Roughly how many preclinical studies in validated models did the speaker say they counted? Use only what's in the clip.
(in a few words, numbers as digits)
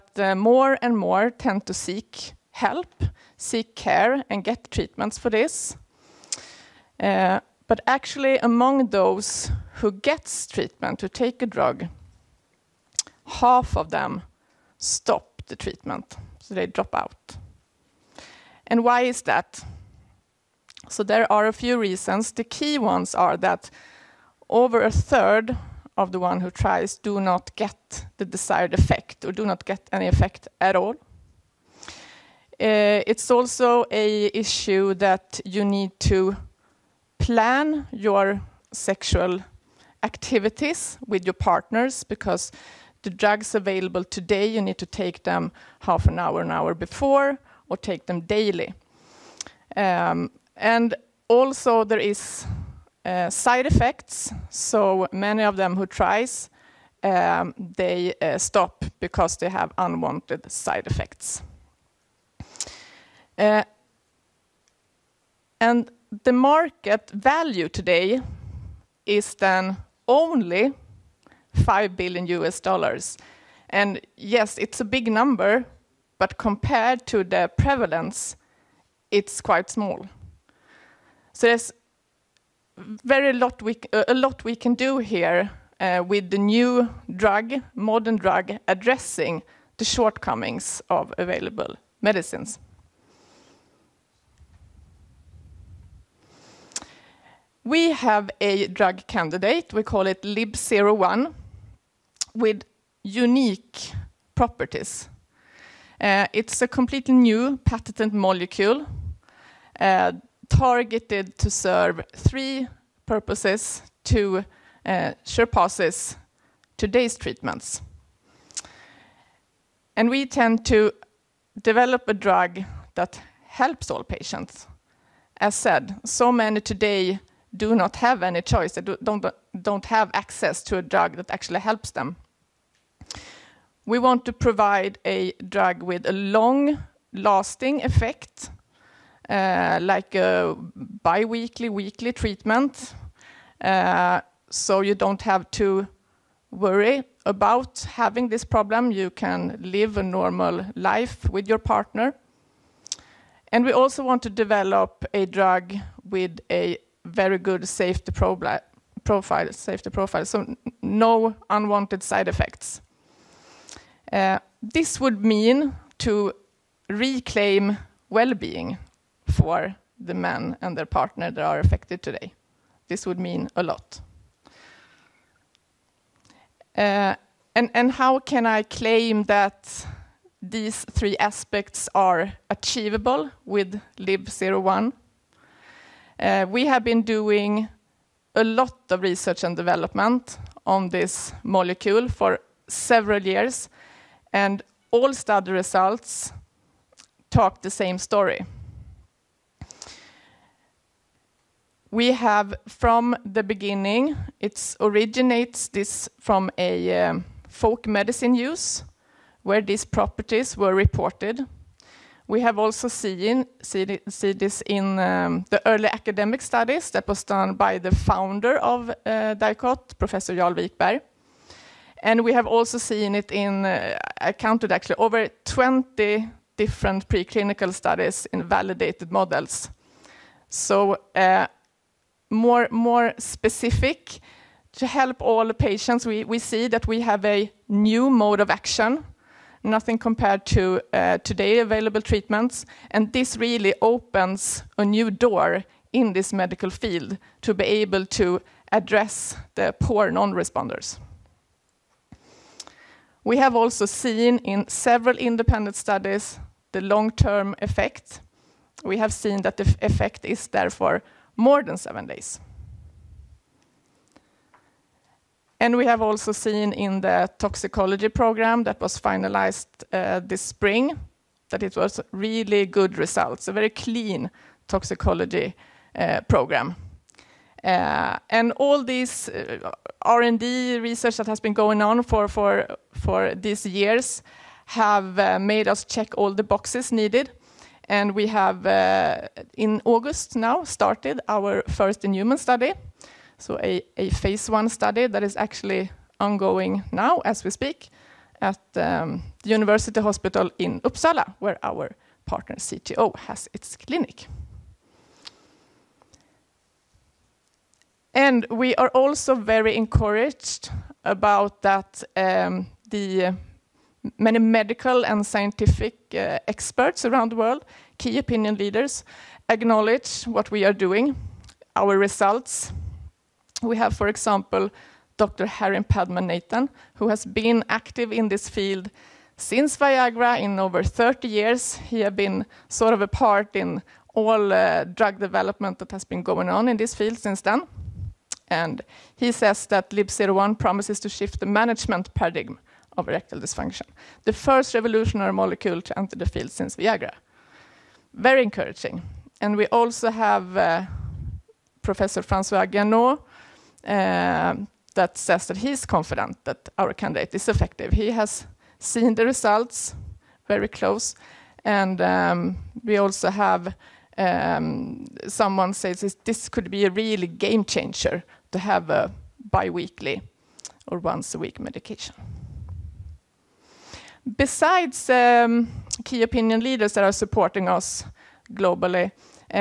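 over 20.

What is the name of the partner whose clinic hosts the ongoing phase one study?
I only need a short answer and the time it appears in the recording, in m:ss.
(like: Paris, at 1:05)
CTC, at 5:02.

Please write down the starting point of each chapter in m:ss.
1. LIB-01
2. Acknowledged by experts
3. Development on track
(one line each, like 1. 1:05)
1. 1:36
2. 5:07
3. 2:56.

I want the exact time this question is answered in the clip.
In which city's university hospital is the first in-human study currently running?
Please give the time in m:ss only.
5:00.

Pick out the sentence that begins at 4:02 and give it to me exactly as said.
And this really opens a new door in this medical field to be able to address the poor non responders.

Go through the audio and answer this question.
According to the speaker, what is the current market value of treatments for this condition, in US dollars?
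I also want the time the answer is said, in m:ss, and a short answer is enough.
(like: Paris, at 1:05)
5 billion US dollars, at 1:11.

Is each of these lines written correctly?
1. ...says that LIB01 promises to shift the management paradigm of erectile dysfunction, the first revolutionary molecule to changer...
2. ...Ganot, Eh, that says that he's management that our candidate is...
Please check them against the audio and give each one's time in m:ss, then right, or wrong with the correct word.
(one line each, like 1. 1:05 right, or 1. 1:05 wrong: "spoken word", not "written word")
1. 5:39 wrong: "enter", not "changer"
2. 5:52 wrong: "confident", not "management".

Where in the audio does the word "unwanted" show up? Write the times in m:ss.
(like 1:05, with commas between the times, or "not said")
0:59, 2:41.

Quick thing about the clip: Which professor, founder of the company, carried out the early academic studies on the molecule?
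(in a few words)
Jarl Wikberg.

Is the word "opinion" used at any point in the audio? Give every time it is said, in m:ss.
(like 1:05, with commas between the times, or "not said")
5:18, 6:16.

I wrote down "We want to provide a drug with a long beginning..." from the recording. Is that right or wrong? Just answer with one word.
wrong.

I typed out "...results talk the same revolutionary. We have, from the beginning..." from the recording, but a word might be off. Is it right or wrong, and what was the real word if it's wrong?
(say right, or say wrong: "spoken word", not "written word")
wrong: "story", not "revolutionary".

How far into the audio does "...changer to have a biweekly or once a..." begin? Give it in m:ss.
6:07.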